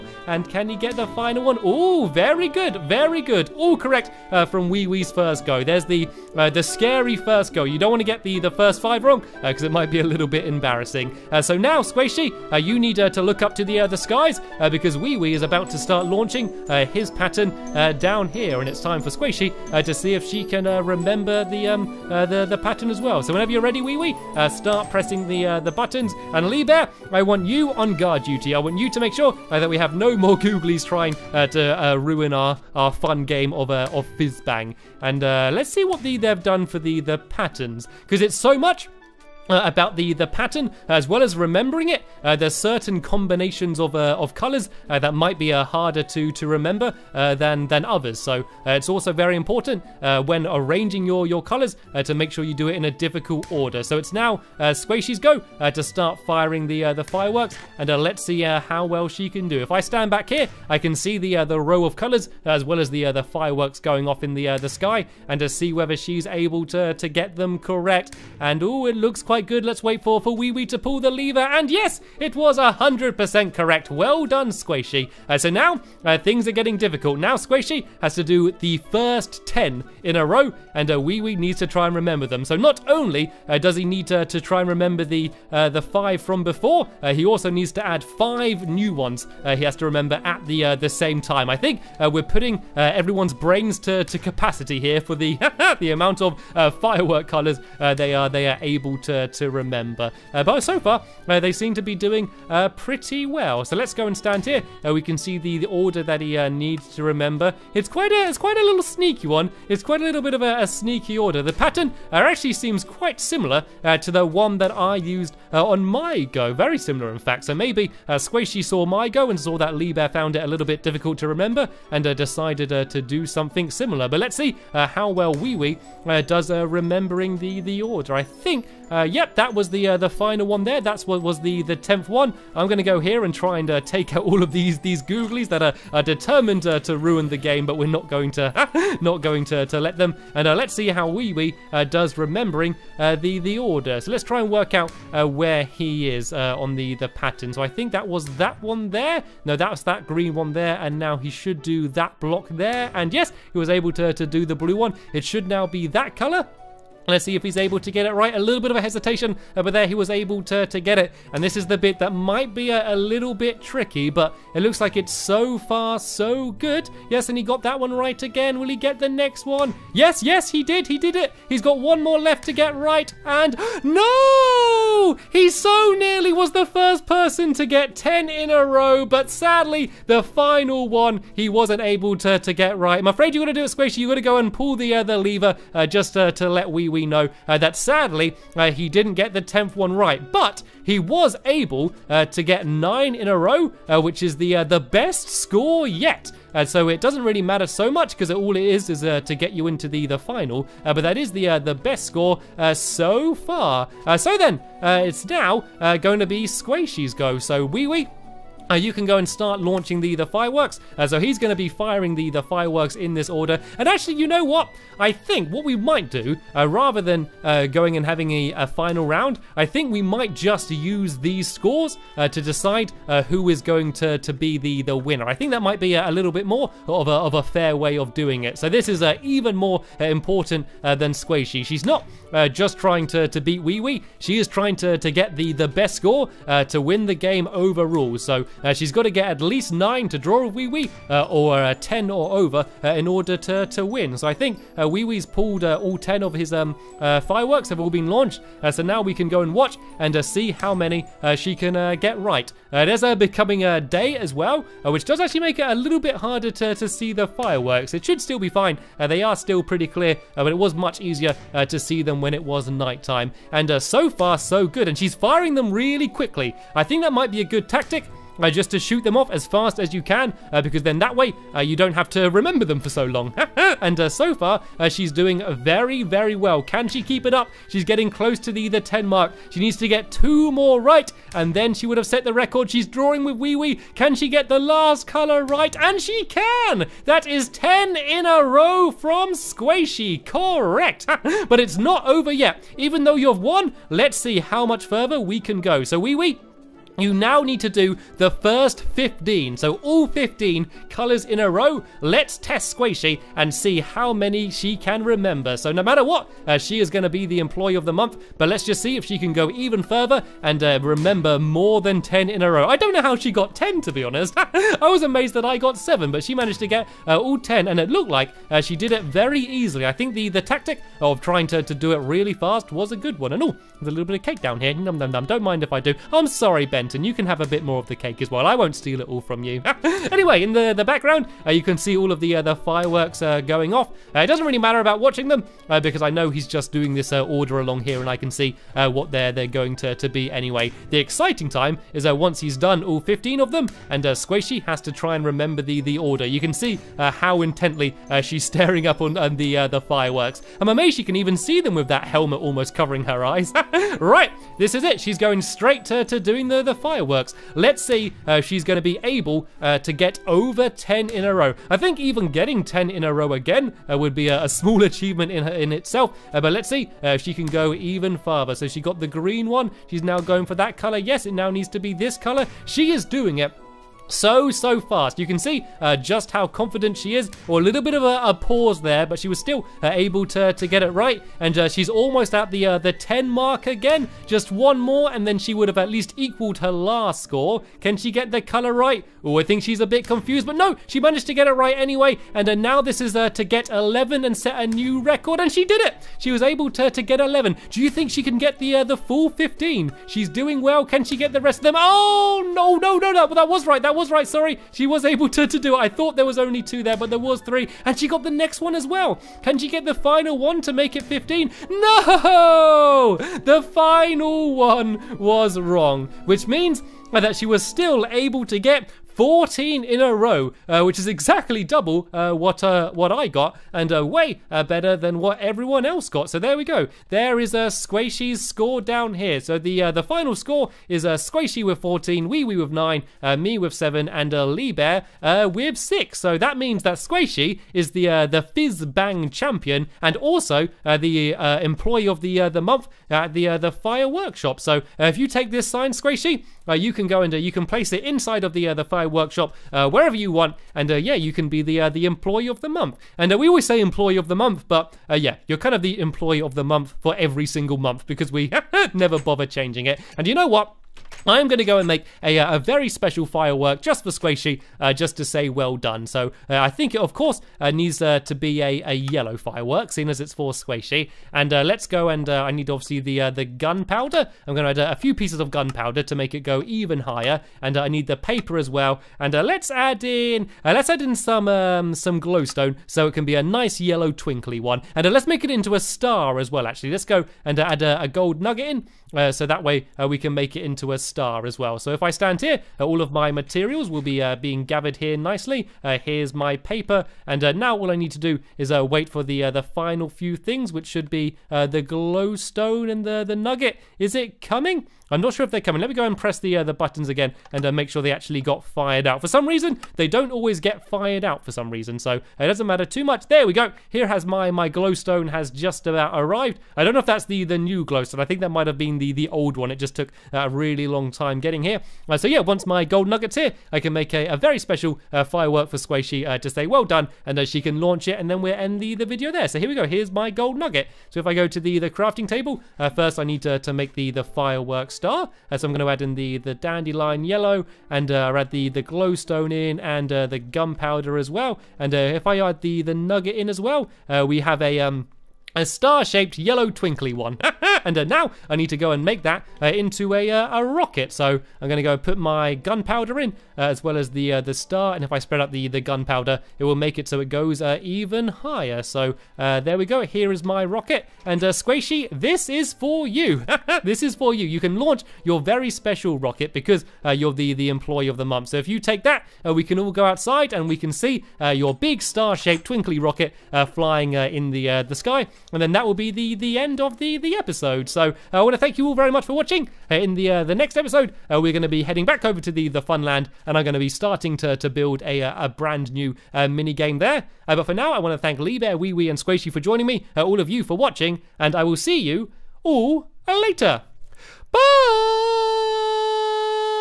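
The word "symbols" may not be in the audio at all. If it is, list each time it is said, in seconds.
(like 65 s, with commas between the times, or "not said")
not said.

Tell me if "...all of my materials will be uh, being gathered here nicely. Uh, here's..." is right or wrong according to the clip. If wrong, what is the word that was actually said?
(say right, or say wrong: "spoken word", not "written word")
right.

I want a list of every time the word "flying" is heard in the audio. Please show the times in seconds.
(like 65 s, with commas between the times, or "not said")
573 s.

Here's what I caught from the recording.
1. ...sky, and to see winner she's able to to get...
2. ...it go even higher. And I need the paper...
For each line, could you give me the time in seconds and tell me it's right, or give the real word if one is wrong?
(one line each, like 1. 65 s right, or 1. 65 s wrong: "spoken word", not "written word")
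1. 64 s wrong: "whether", not "winner"
2. 476 s right.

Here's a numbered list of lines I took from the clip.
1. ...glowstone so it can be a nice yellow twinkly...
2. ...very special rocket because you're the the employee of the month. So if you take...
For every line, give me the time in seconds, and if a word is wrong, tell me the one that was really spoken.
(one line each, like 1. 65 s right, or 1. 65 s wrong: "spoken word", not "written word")
1. 482 s right
2. 565 s right.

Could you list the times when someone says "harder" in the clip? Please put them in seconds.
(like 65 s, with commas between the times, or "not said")
45 s, 256 s.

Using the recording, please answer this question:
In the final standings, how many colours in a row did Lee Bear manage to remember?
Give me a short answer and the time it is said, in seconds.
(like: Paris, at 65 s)
6, at 435 s.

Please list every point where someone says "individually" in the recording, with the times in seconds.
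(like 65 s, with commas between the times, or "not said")
not said.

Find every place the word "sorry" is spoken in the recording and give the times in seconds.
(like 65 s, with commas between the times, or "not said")
326 s, 404 s.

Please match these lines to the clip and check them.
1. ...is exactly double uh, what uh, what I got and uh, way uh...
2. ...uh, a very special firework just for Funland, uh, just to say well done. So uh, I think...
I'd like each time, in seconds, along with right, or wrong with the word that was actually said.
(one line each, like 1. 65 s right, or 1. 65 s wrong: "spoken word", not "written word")
1. 420 s right
2. 462 s wrong: "Squishy", not "Funland".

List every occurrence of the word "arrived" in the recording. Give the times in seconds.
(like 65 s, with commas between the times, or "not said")
516 s.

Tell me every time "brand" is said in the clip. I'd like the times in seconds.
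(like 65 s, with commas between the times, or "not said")
585 s.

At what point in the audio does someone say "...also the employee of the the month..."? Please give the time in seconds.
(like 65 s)
440 s.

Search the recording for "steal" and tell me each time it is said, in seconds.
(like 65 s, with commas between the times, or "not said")
328 s.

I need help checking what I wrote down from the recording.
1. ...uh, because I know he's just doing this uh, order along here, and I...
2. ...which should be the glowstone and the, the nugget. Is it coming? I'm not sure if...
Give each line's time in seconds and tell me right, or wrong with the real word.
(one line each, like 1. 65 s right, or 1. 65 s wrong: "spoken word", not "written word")
1. 335 s right
2. 500 s right.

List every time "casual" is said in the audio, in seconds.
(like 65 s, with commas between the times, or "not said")
not said.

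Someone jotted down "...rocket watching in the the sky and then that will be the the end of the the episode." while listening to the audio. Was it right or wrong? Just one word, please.
wrong.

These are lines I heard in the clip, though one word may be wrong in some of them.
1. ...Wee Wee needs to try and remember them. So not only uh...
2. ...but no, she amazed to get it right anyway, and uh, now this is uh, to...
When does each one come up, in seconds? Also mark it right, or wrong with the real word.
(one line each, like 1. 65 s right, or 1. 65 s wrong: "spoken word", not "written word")
1. 80 s right
2. 390 s wrong: "managed", not "amazed".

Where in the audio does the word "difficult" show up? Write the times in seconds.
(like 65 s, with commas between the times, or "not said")
52 s, 76 s, 120 s.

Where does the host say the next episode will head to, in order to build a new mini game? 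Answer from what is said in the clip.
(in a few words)
the Funland.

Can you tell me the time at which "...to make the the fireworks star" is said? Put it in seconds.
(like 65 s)
533 s.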